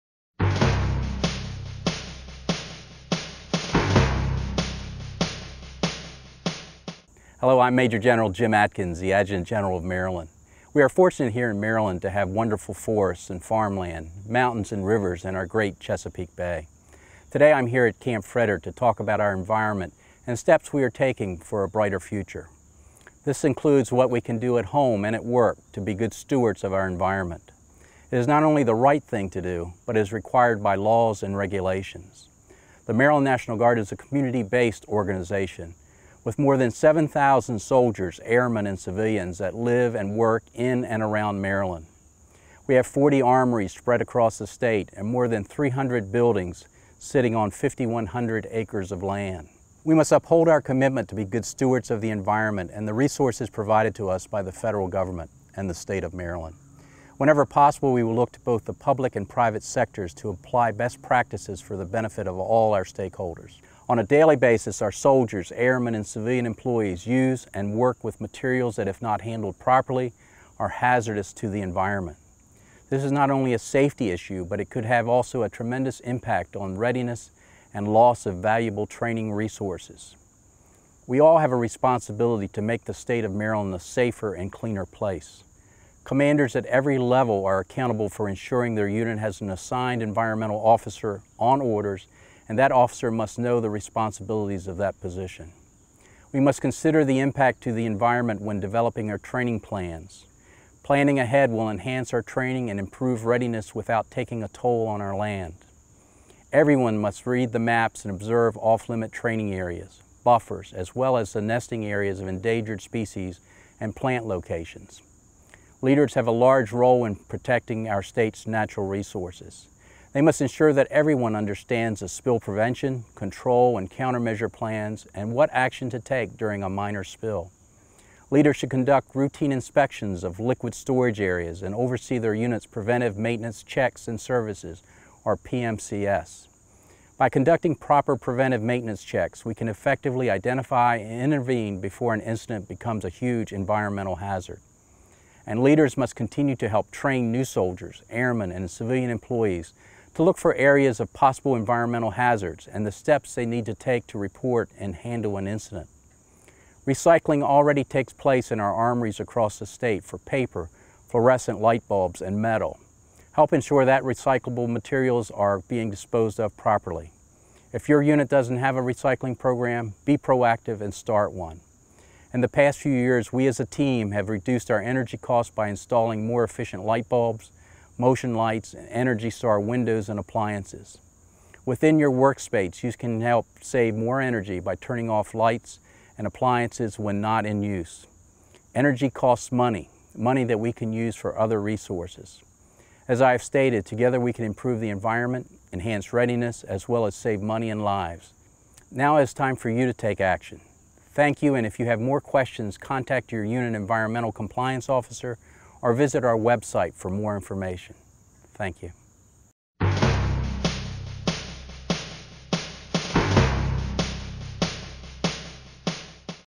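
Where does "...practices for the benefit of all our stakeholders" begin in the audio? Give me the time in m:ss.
1:01.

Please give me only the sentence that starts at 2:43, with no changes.
Help ensure that recyclable materials are being disposed of properly.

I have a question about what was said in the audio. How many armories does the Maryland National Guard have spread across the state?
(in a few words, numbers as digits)
40.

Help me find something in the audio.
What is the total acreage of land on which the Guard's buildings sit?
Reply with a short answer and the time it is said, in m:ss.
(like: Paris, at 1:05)
5,100 acres, at 0:47.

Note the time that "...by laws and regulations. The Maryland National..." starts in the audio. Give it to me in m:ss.
0:30.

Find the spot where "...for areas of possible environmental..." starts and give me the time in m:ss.
2:30.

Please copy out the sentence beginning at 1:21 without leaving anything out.
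We all have a responsibility to make the state of Maryland a safer and cleaner place.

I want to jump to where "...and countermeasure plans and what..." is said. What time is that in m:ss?
2:03.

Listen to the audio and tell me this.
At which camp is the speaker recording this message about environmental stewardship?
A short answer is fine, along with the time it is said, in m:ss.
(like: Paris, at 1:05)
Camp Frederick, at 0:17.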